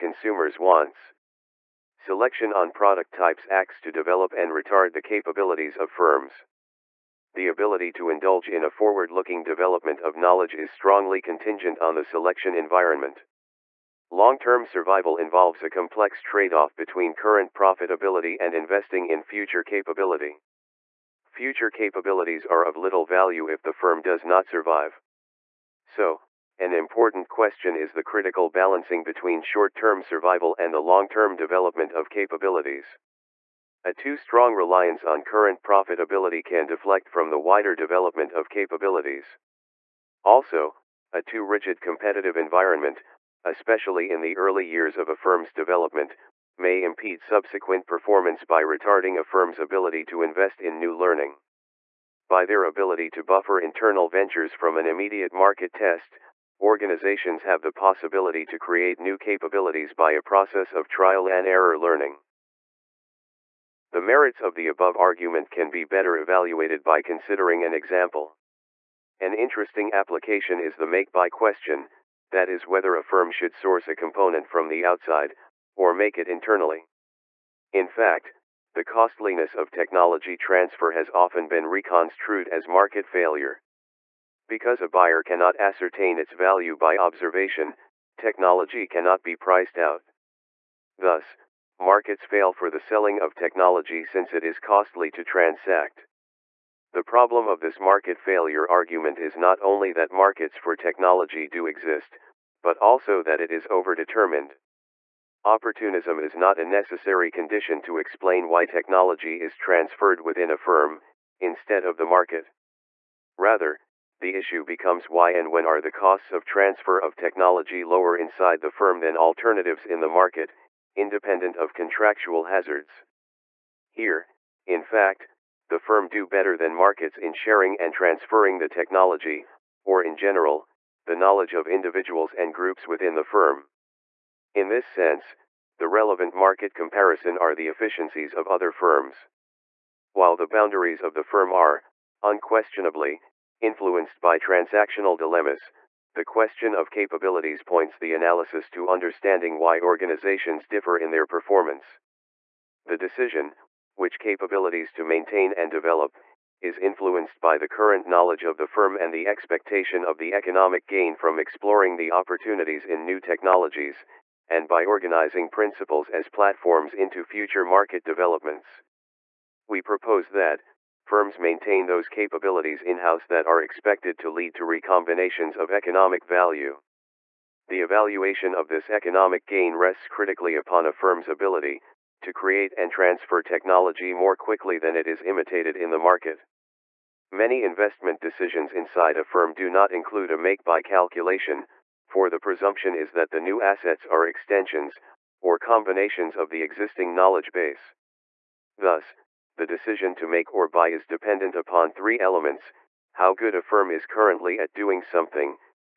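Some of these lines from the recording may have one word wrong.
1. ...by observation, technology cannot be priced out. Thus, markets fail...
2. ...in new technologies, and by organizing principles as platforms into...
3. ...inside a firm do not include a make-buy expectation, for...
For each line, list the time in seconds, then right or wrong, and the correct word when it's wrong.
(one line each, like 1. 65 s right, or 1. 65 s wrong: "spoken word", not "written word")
1. 86 s right
2. 162 s right
3. 188 s wrong: "calculation", not "expectation".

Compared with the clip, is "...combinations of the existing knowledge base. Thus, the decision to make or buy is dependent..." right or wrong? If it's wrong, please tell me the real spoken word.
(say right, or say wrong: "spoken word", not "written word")
right.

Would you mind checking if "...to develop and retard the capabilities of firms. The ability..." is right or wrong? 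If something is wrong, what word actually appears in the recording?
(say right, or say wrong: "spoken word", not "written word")
right.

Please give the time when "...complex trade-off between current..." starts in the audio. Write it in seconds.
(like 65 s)
15 s.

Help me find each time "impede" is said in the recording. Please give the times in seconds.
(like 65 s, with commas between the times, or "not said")
46 s.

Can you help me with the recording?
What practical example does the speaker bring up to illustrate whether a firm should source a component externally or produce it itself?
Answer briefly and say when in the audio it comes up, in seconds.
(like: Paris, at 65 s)
make-buy question, at 70 s.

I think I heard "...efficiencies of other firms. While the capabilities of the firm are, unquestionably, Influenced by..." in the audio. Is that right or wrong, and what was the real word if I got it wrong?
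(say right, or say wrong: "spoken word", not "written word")
wrong: "boundaries", not "capabilities".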